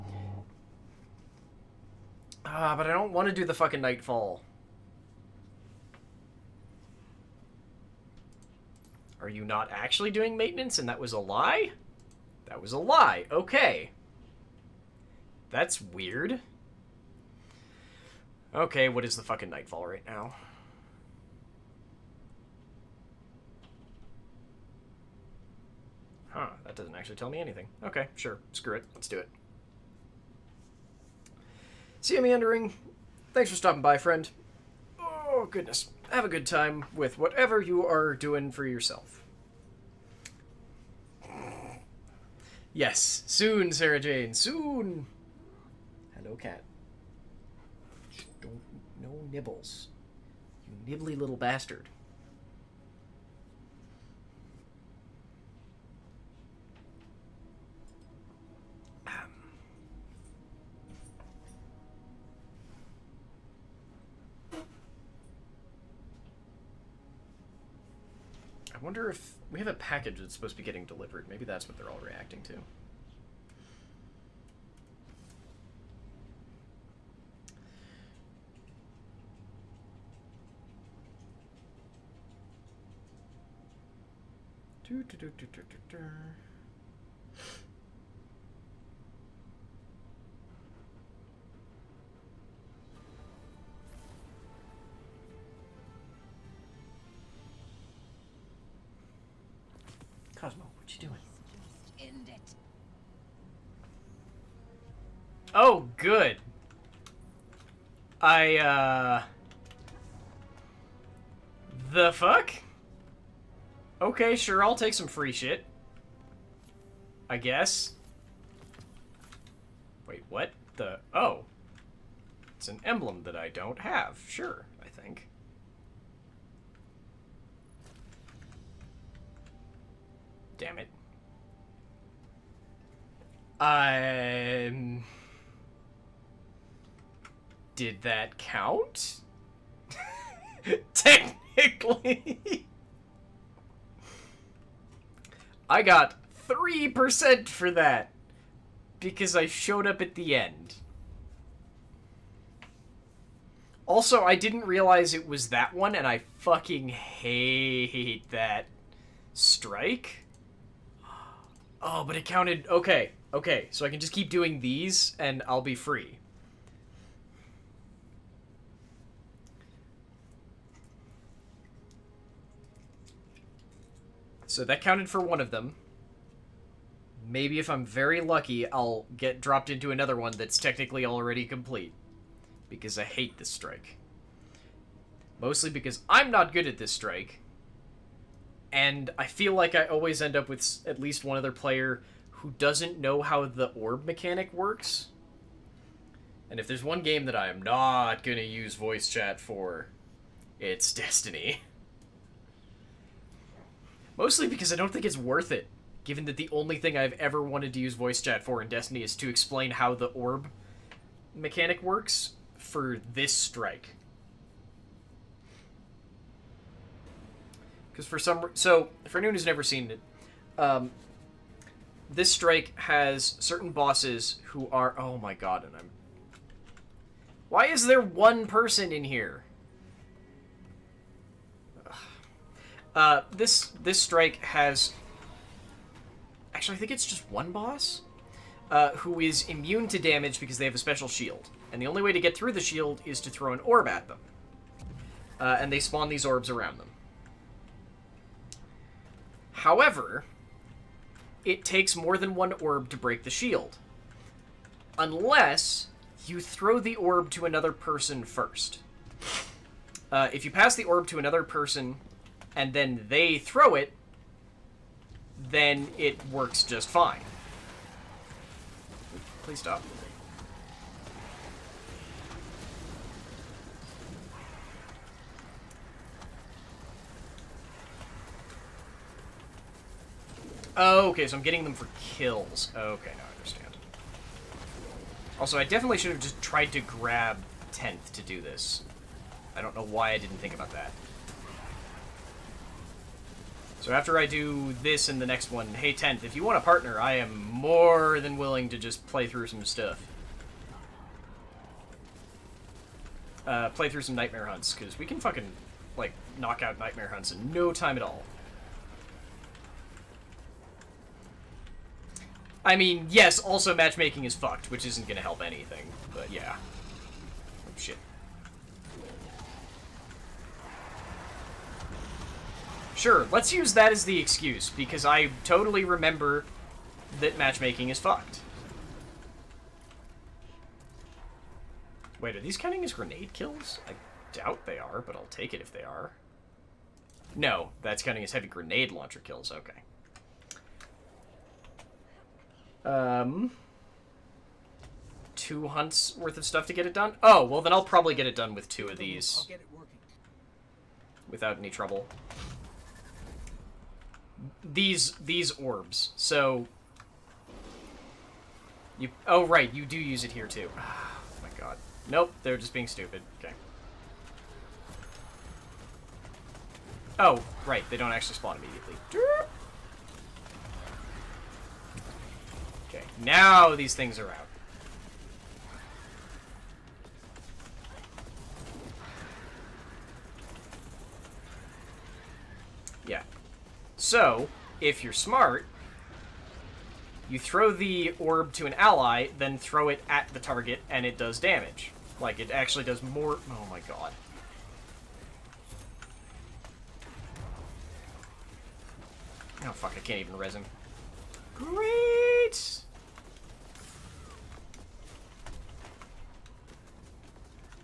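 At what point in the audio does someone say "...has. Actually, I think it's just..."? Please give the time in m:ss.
3:54.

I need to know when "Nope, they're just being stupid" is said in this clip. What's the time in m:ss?
6:02.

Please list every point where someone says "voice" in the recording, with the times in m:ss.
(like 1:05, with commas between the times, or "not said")
3:18, 3:27.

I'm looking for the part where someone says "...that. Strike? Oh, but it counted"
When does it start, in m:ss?
2:38.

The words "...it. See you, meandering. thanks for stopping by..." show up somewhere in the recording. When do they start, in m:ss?
0:29.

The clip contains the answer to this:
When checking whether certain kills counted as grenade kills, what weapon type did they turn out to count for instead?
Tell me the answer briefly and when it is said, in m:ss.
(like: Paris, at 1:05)
heavy grenade launcher, at 5:38.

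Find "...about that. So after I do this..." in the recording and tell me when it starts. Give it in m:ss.
4:50.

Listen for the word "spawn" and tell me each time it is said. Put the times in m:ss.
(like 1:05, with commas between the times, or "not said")
4:05, 6:08.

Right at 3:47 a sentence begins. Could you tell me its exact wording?
Why is there one person in here?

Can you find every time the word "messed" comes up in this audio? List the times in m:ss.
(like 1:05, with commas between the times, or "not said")
not said.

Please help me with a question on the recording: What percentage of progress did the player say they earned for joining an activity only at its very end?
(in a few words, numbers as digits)
3%.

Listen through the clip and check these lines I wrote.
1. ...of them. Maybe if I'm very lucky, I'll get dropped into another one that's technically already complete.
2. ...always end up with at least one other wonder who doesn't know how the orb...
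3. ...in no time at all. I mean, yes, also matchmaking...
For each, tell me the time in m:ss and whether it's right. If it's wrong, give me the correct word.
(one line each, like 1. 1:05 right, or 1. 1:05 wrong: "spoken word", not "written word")
1. 2:55 right
2. 3:09 wrong: "player", not "wonder"
3. 5:07 right.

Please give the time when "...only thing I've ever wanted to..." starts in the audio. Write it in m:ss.
3:26.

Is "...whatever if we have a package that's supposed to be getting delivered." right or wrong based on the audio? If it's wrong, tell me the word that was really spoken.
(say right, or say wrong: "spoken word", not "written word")
wrong: "wonder", not "whatever".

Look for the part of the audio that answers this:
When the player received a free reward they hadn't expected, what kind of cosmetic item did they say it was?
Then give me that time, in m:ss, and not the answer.
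2:02.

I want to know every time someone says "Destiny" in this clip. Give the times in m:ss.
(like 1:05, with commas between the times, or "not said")
3:20, 3:28.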